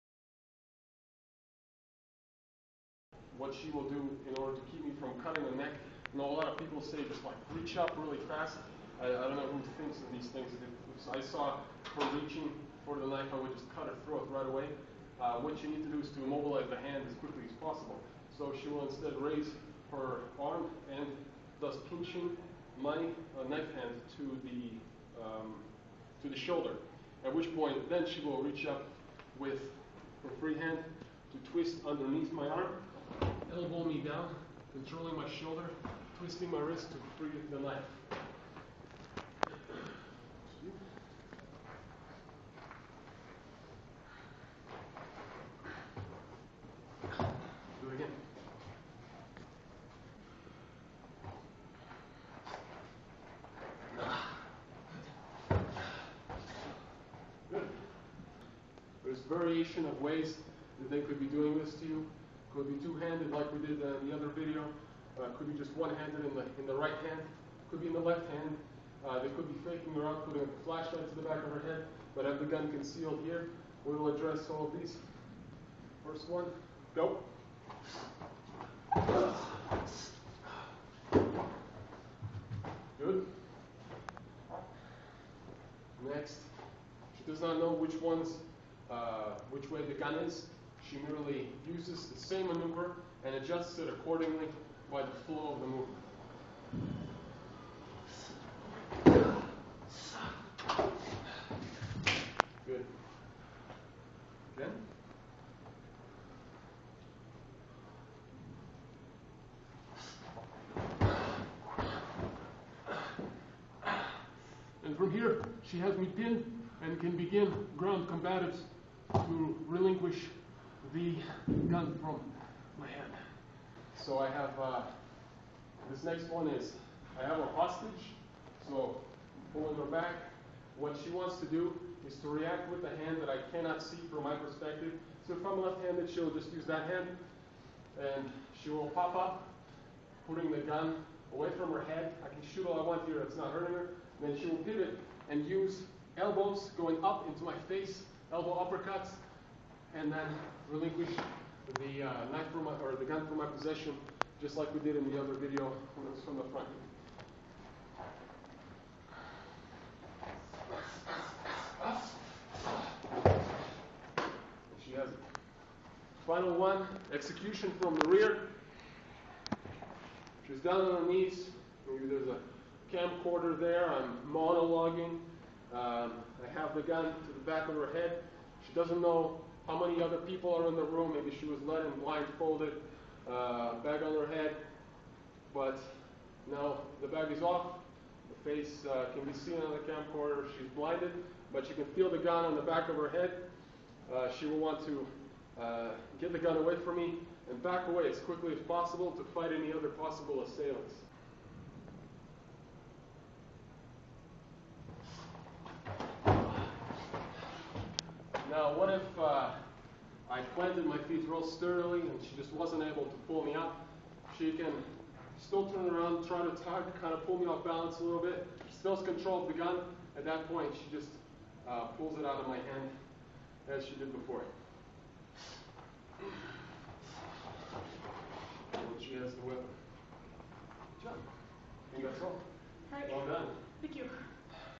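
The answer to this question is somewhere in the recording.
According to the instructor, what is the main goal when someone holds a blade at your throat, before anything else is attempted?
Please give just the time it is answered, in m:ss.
0:16.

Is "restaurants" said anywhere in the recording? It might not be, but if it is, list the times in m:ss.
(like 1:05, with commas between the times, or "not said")
not said.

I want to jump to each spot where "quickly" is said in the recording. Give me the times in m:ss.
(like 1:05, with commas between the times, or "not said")
0:17, 3:18.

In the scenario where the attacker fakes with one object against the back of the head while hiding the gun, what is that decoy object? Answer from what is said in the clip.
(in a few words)
A flashlight.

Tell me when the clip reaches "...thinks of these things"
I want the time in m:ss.
0:09.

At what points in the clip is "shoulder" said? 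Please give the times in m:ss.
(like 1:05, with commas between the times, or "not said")
0:26, 0:35.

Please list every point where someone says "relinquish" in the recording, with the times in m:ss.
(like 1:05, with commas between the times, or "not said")
1:59, 2:30.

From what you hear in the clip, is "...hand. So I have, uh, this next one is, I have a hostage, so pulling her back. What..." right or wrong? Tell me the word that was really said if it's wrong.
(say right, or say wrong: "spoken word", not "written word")
right.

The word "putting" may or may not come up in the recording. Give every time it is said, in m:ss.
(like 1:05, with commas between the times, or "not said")
1:10, 2:20.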